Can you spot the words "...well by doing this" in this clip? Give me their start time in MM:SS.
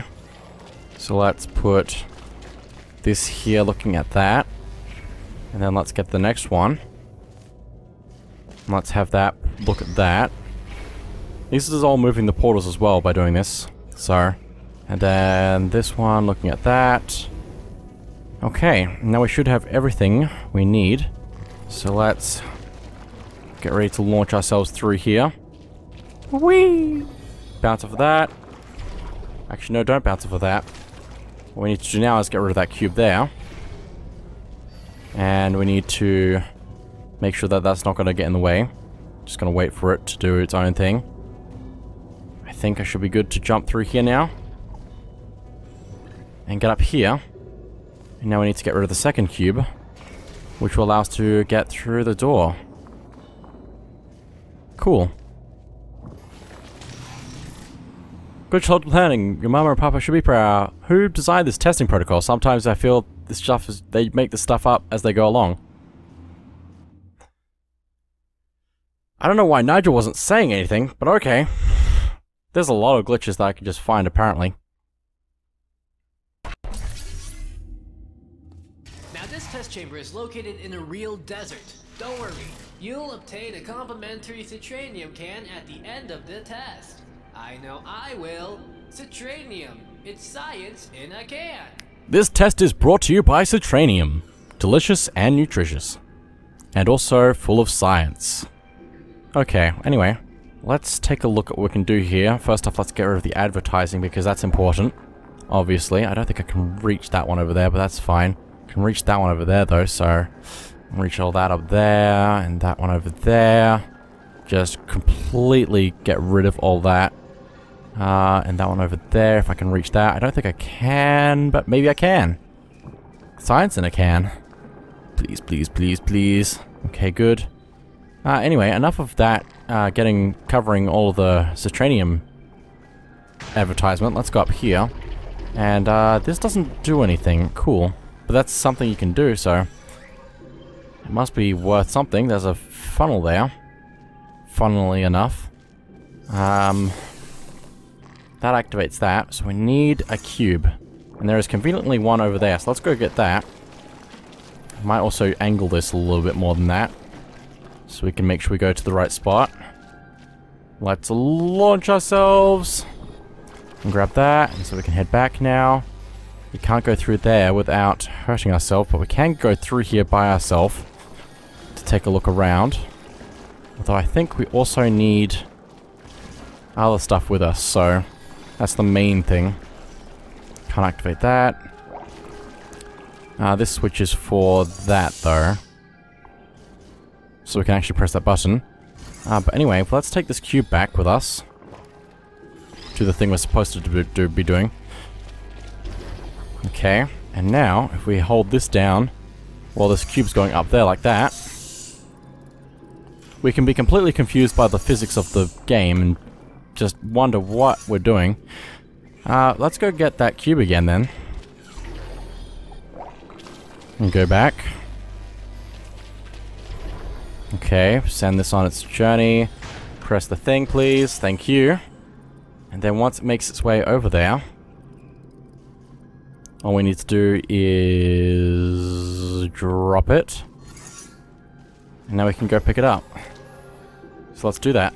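00:12.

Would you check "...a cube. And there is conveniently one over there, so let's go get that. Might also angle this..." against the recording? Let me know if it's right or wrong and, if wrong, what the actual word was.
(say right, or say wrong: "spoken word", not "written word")
right.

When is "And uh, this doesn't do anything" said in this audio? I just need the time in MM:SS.
02:15.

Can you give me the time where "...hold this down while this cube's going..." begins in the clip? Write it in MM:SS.
03:18.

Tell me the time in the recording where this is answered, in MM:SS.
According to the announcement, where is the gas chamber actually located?
01:20.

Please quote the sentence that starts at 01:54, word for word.
Just completely get rid of all that.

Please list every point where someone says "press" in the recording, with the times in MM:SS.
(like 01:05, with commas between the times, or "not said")
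03:07, 03:39.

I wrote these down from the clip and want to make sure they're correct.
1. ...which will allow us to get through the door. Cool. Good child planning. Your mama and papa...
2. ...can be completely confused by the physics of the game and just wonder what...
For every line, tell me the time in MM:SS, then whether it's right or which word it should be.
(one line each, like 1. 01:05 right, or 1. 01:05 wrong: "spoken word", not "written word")
1. 00:50 right
2. 03:23 right.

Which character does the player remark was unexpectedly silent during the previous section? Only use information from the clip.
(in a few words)
Nigel.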